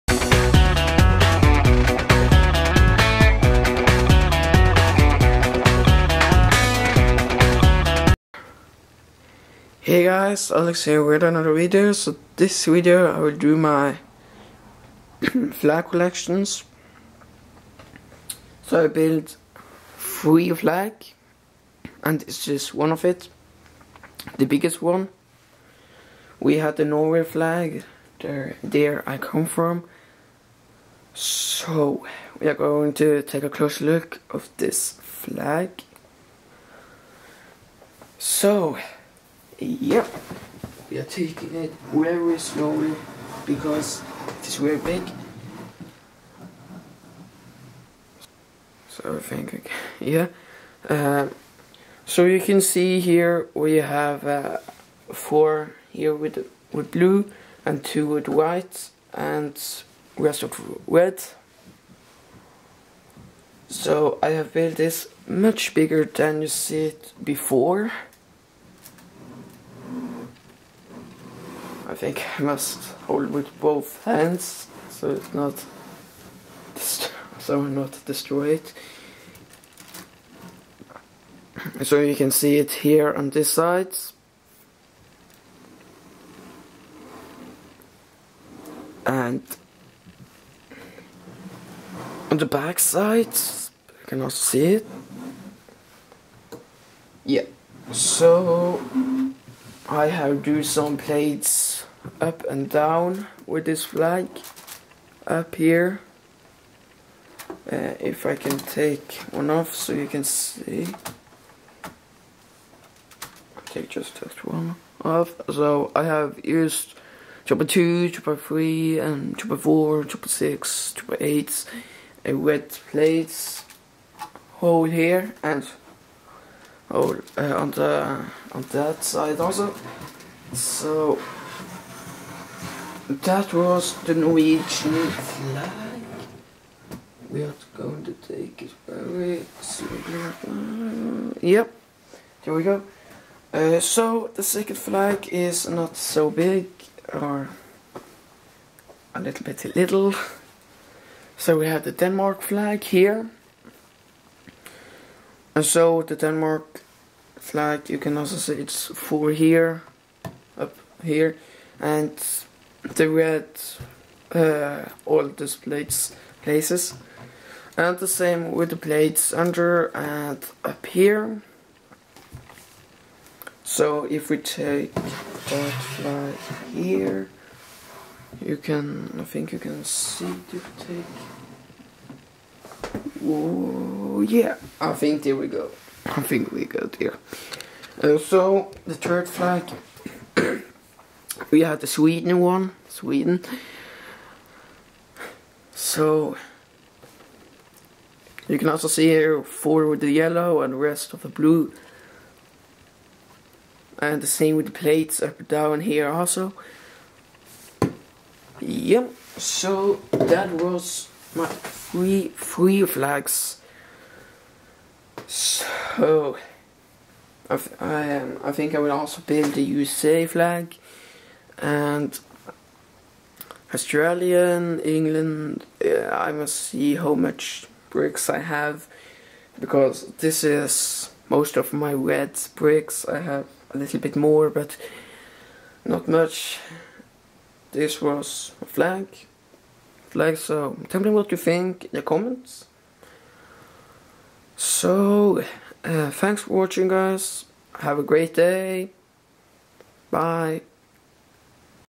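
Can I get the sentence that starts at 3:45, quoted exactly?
I must see how much bricks I have because this is most of my red bricks.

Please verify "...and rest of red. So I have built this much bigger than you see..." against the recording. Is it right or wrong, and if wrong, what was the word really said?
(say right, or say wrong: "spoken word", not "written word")
right.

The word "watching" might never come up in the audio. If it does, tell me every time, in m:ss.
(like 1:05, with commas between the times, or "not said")
4:06.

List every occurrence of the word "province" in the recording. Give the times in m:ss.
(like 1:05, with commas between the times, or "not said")
not said.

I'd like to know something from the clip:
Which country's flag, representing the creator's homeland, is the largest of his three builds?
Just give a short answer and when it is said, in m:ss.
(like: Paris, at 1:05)
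Norway, at 0:26.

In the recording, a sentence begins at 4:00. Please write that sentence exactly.
Flag, so tell me what you think in the comments.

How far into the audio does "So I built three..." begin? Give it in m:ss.
0:18.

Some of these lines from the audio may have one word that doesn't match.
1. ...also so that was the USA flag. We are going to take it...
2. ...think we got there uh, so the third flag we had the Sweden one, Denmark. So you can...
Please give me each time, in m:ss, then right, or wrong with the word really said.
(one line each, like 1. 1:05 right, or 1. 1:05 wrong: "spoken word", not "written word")
1. 2:09 wrong: "Norwegian", not "USA"
2. 3:06 wrong: "Sweden", not "Denmark".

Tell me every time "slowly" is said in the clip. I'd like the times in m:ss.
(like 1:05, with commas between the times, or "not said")
0:42, 2:19.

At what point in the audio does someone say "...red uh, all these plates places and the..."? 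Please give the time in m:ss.
2:43.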